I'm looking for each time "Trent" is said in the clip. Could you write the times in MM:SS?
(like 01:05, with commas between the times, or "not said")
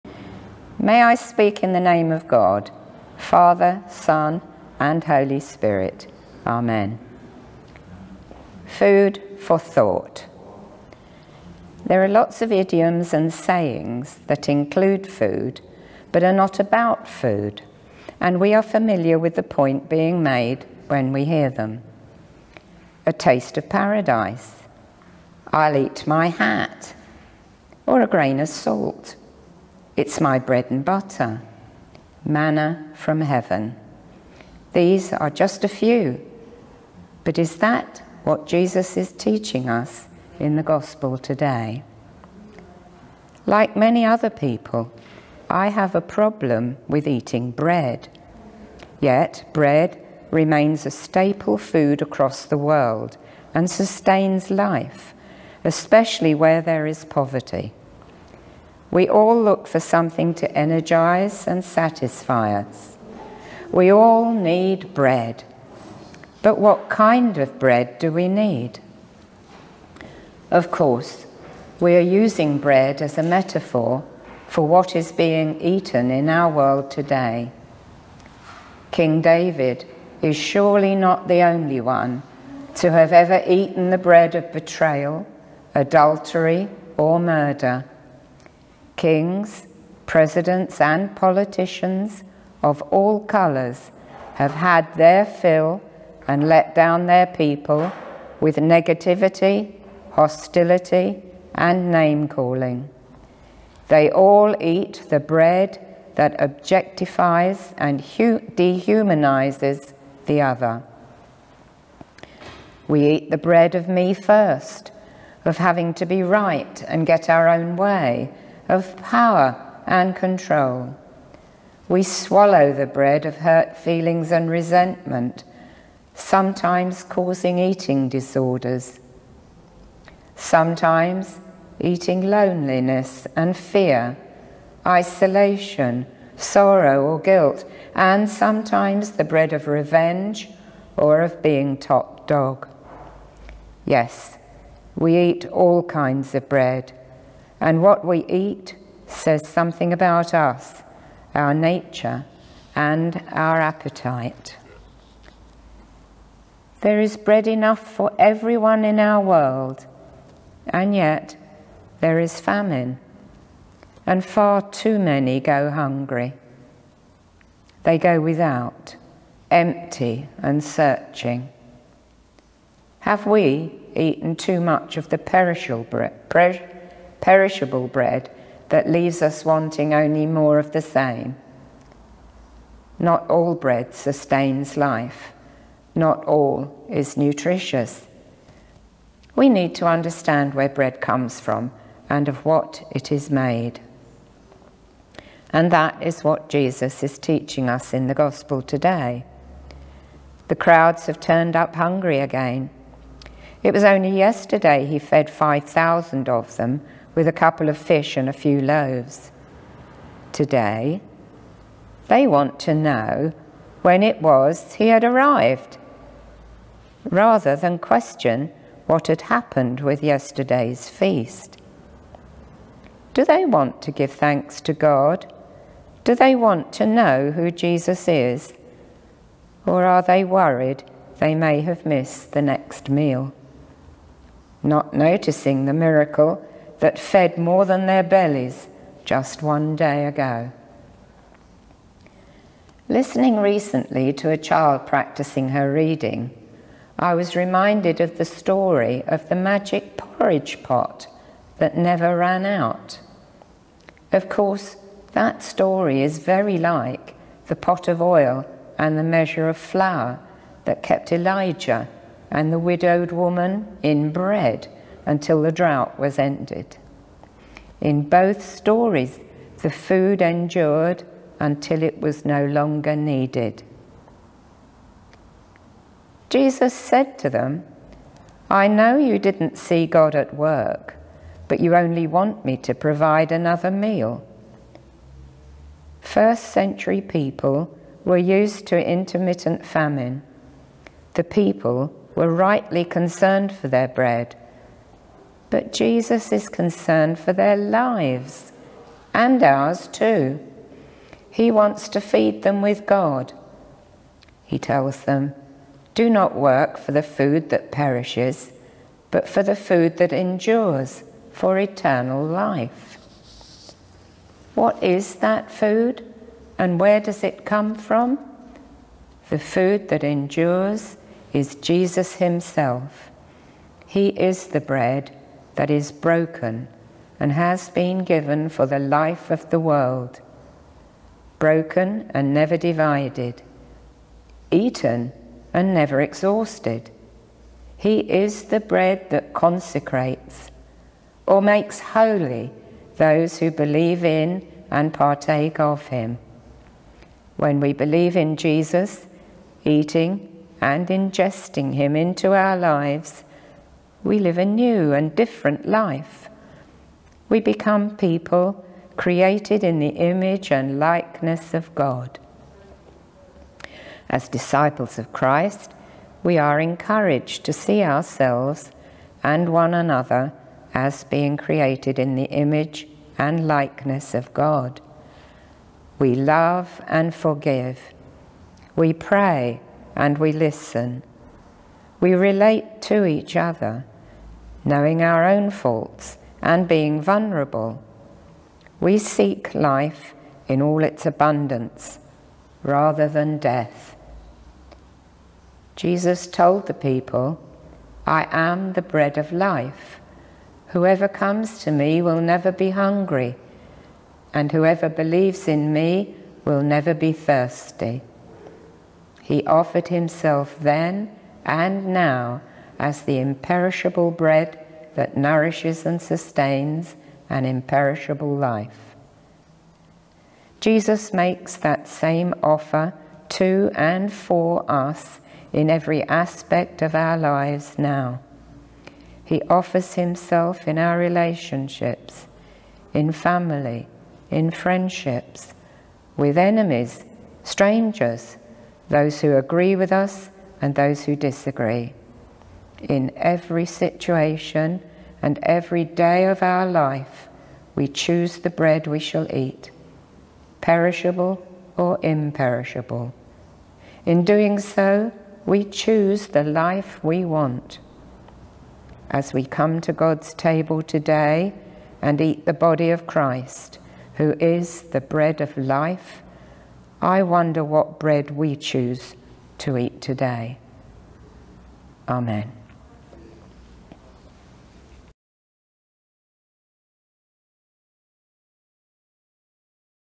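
not said.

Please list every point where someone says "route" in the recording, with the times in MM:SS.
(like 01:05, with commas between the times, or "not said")
not said.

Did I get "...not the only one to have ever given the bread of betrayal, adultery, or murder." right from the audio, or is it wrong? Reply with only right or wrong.
wrong.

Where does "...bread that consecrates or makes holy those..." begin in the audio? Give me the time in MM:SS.
05:38.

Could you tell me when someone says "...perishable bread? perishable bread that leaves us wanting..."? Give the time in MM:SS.
02:55.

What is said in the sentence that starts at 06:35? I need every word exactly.
Jesus told the people, I am the bread of life.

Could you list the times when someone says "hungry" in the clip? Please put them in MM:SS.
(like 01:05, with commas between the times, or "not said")
02:45, 03:21, 06:42.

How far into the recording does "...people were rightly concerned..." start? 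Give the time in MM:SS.
04:51.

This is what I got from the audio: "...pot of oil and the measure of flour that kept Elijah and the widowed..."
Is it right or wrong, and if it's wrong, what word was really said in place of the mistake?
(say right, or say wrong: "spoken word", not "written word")
right.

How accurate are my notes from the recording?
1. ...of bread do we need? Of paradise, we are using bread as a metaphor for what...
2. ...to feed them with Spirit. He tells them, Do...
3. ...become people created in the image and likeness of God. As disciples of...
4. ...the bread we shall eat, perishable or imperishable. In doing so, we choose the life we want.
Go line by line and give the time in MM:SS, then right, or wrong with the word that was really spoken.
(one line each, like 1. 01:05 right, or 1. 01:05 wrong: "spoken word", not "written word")
1. 01:07 wrong: "course", not "paradise"
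2. 05:01 wrong: "God", not "Spirit"
3. 05:57 right
4. 07:28 right.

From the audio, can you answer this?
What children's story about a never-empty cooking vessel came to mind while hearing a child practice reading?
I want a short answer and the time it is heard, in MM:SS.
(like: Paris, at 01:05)
The magic porridge pot, at 04:09.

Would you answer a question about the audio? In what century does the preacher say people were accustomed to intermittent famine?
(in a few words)
First century.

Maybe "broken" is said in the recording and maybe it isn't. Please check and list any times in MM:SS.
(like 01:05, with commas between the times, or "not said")
05:25, 05:31.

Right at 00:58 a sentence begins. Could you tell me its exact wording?
We all look for something to energize and satisfy us.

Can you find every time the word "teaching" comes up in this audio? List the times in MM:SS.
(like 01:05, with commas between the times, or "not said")
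00:39, 03:17.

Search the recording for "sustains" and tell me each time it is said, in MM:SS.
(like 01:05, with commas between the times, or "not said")
00:53, 03:03, 06:56.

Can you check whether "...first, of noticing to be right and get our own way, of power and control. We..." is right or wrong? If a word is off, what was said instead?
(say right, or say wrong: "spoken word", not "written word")
wrong: "having", not "noticing".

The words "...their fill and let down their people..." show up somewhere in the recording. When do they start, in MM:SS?
01:34.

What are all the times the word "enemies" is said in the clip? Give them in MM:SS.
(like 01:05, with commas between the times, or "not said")
07:16.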